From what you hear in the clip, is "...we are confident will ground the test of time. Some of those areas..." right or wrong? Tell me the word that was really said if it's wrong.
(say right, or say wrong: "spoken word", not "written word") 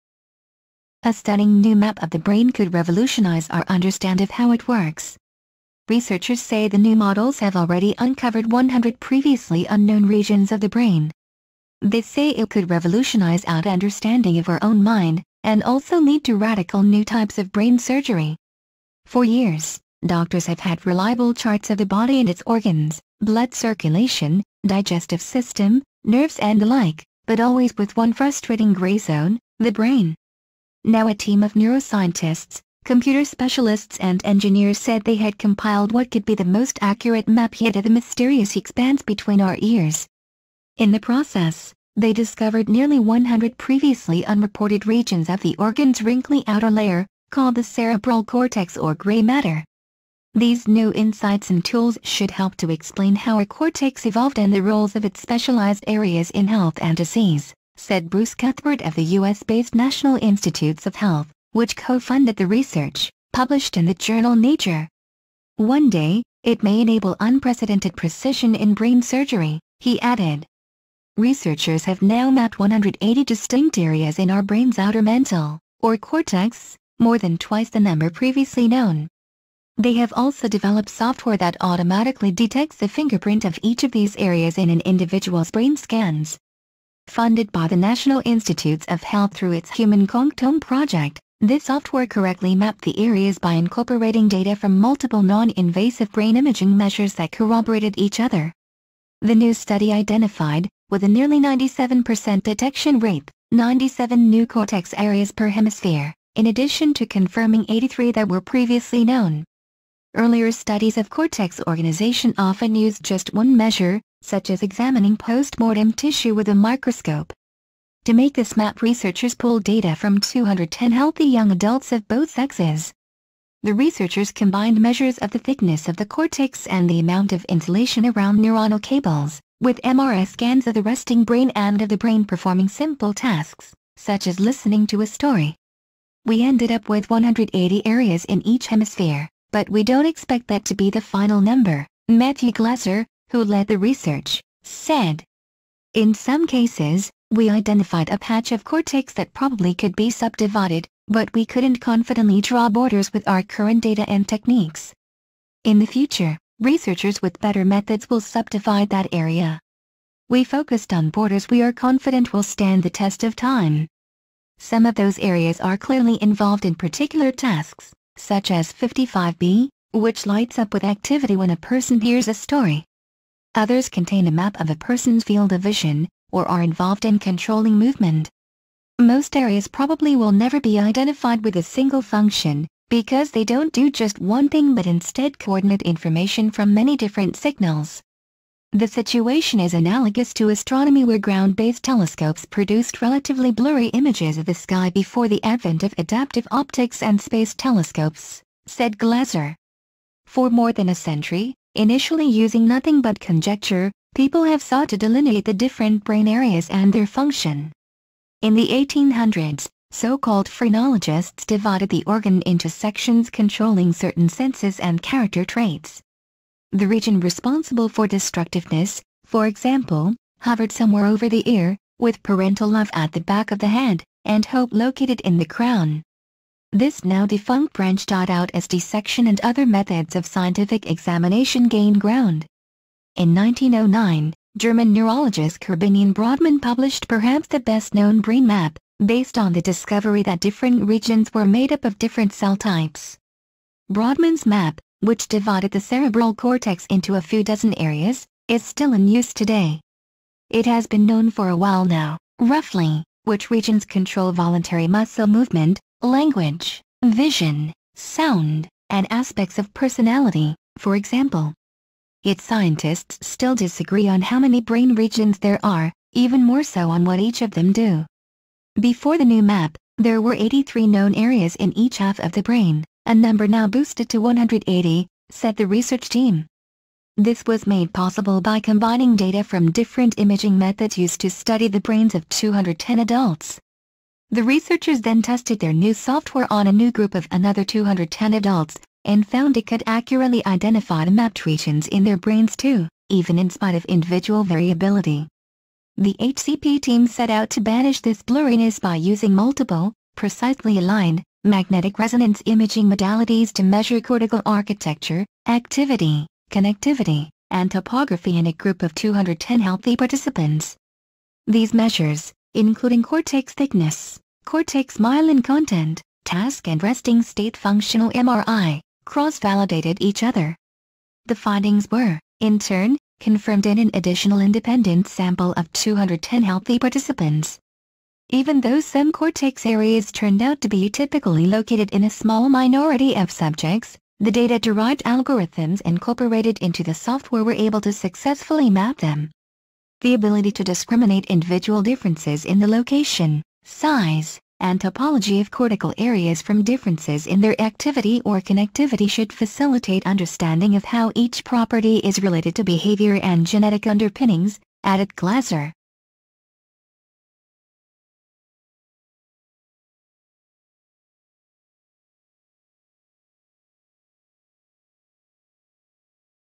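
wrong: "stand", not "ground".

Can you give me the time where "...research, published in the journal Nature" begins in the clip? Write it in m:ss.
1:02.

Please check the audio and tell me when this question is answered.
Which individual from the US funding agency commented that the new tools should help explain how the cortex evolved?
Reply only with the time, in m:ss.
0:58.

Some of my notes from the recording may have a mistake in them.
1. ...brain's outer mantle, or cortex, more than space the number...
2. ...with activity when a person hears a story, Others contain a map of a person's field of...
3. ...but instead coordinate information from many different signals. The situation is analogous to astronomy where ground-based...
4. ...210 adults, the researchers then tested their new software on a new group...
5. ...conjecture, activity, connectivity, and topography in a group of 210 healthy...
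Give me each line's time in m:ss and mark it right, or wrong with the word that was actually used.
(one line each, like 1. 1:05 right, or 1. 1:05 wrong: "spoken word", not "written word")
1. 1:14 wrong: "twice", not "space"
2. 2:50 right
3. 3:04 right
4. 4:42 right
5. 5:04 wrong: "architecture", not "conjecture".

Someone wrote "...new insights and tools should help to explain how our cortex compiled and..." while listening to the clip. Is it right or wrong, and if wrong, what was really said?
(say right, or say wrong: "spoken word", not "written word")
wrong: "evolved", not "compiled".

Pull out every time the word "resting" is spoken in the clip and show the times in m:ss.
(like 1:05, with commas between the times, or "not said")
2:10, 5:16.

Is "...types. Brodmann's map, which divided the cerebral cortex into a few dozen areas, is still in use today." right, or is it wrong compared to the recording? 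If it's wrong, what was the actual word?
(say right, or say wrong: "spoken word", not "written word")
right.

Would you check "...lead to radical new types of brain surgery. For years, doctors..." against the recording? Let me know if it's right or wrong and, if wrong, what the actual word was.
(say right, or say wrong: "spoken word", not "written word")
right.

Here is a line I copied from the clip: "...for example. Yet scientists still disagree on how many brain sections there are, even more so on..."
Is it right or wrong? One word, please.
wrong.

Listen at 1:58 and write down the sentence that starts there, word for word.
To make this map researchers pulled data from 210 healthy young adults of both sexes.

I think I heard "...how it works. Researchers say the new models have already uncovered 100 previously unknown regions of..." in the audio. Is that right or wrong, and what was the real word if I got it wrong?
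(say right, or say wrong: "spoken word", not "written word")
right.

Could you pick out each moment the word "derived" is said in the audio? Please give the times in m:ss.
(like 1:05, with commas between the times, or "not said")
5:34.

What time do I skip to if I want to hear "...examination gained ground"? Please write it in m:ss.
3:50.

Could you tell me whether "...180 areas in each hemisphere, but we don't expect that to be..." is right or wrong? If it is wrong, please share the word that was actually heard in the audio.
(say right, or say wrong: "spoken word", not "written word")
right.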